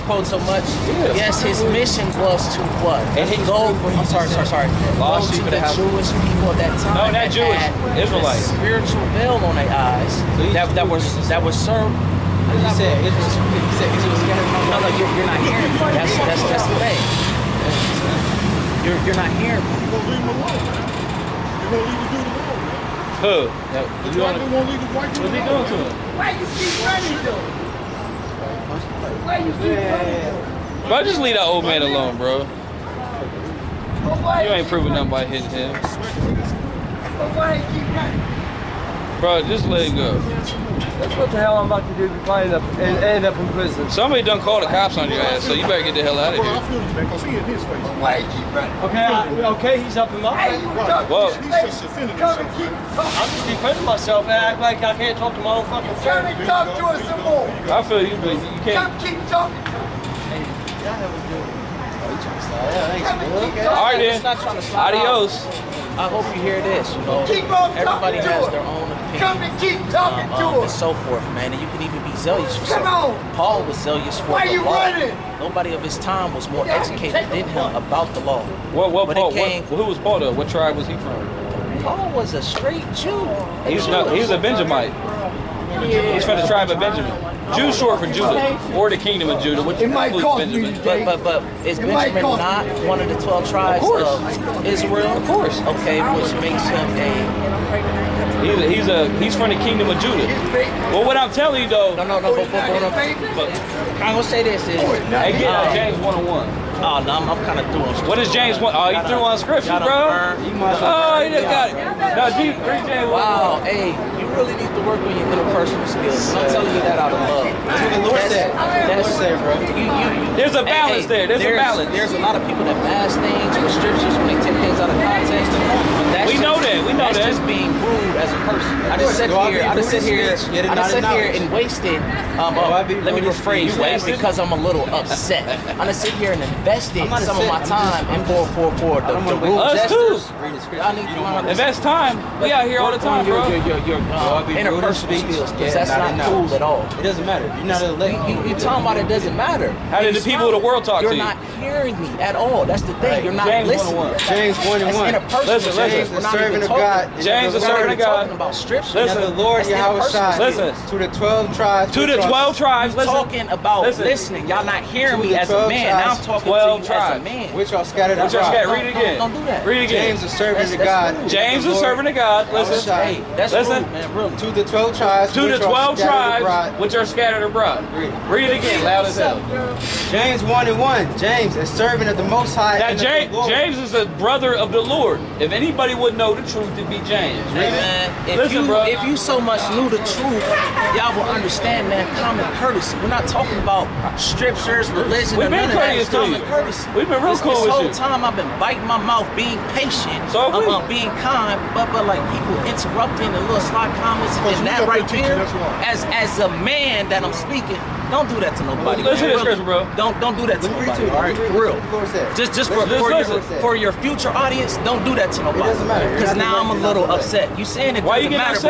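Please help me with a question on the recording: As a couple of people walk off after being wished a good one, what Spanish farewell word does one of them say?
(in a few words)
Adios.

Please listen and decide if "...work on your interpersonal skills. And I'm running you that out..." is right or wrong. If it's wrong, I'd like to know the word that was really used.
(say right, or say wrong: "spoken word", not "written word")
wrong: "telling", not "running".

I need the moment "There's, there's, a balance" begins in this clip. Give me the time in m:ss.
2:01.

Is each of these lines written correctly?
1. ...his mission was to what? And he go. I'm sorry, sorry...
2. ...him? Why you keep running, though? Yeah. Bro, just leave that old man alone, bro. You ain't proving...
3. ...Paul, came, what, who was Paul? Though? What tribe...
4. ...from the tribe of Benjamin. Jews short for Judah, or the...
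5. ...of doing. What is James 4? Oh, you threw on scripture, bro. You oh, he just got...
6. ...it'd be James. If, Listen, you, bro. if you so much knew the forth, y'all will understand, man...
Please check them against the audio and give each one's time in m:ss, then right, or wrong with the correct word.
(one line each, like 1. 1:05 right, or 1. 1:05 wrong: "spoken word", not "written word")
1. 0:01 right
2. 0:25 right
3. 1:19 right
4. 1:26 right
5. 1:47 wrong: "1", not "4"
6. 3:06 wrong: "truth", not "forth".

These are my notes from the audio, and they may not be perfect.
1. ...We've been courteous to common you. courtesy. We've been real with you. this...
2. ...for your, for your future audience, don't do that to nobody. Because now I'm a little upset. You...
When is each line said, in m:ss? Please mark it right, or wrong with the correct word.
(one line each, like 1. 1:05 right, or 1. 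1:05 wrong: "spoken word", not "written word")
1. 3:15 right
2. 3:32 right.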